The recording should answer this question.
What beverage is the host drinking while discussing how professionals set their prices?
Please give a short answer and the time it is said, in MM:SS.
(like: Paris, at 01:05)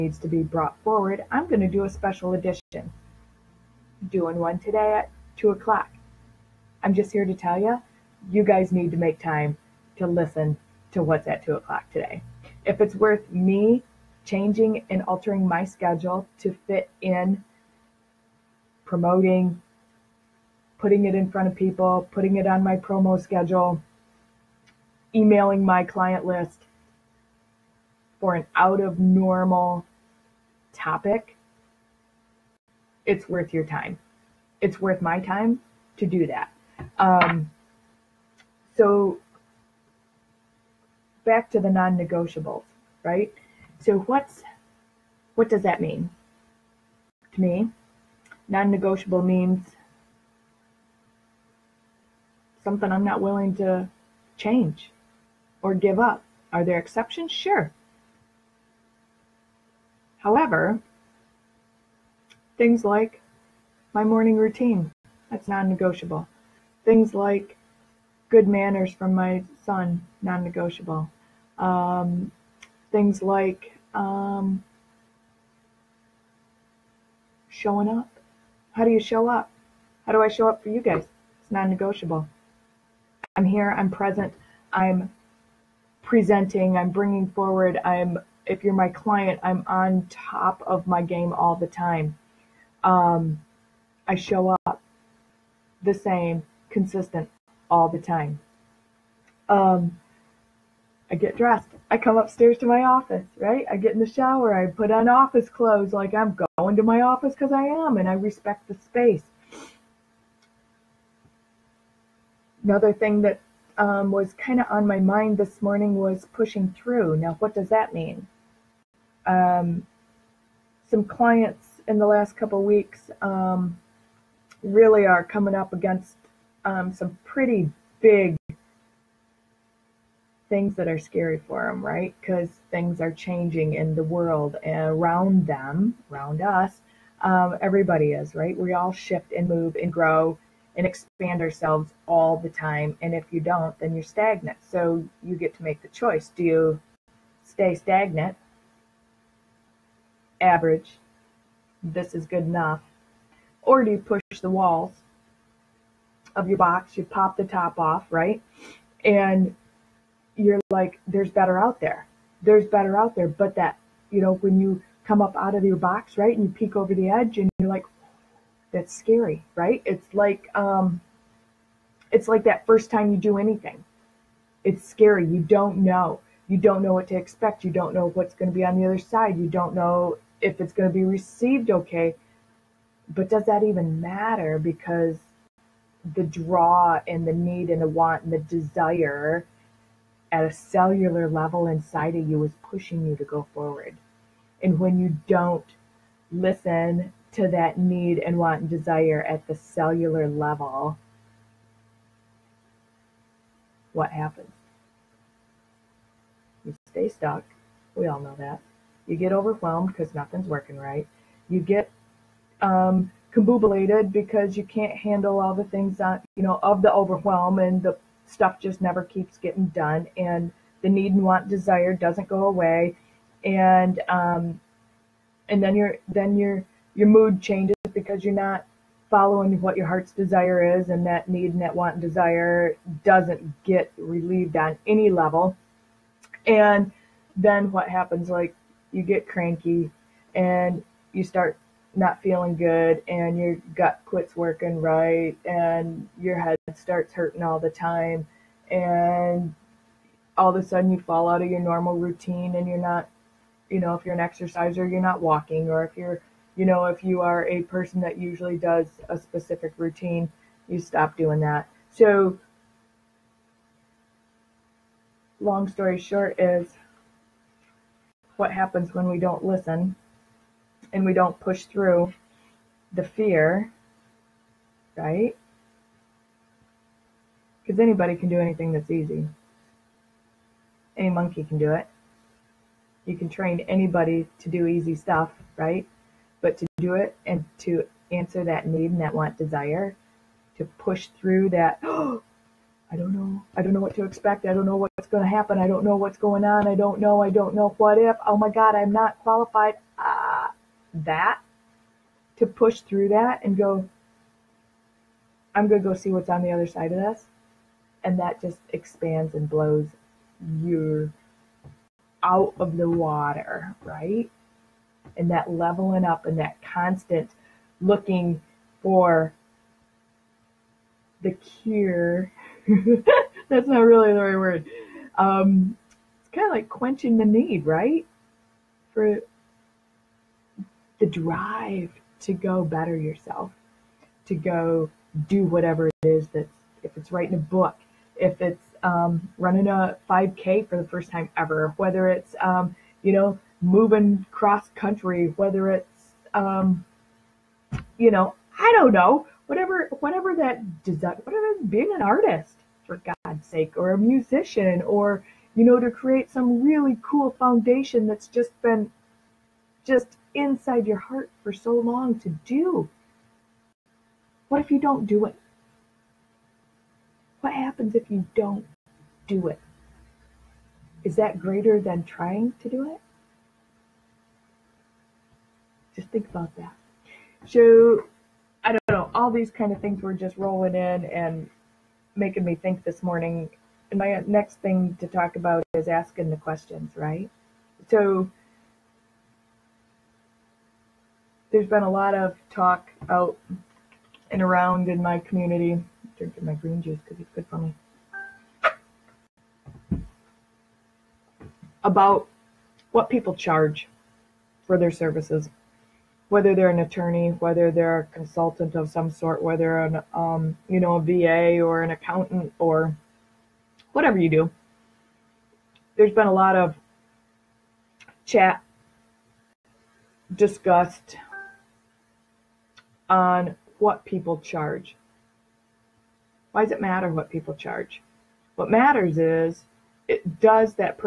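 Green juice, at 06:36.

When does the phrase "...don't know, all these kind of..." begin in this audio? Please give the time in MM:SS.
06:18.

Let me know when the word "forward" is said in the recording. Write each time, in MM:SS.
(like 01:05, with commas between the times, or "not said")
00:00, 01:27, 03:13.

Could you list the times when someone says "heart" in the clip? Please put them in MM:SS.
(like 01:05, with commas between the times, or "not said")
03:49, 06:00.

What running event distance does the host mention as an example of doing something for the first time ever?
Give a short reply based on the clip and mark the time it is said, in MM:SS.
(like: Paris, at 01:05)
5K, at 05:40.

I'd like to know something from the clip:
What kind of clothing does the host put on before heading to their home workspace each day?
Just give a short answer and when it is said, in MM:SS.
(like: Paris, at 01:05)
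Office clothes, at 01:45.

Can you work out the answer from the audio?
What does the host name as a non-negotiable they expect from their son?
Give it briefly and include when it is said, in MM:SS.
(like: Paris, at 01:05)
Good manners, at 01:08.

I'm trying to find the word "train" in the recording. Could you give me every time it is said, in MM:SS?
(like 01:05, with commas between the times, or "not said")
04:43.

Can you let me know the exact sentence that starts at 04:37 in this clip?
Because anybody can do anything that's easy.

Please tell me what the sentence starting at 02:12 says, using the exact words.
Because things are changing in the world and around them, around us.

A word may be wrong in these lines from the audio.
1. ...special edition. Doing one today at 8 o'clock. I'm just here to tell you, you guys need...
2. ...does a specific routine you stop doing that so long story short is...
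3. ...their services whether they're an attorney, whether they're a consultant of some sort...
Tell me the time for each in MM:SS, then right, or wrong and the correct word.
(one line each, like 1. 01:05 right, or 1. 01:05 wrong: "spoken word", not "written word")
1. 00:01 wrong: "2", not "8"
2. 04:18 right
3. 06:44 right.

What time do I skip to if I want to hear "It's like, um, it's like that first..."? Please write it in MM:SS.
02:49.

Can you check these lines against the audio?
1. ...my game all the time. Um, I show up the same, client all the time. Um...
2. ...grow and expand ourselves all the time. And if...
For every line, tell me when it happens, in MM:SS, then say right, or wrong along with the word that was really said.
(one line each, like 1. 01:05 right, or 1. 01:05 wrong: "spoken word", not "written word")
1. 01:30 wrong: "consistent", not "client"
2. 02:19 right.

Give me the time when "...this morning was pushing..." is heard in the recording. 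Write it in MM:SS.
01:55.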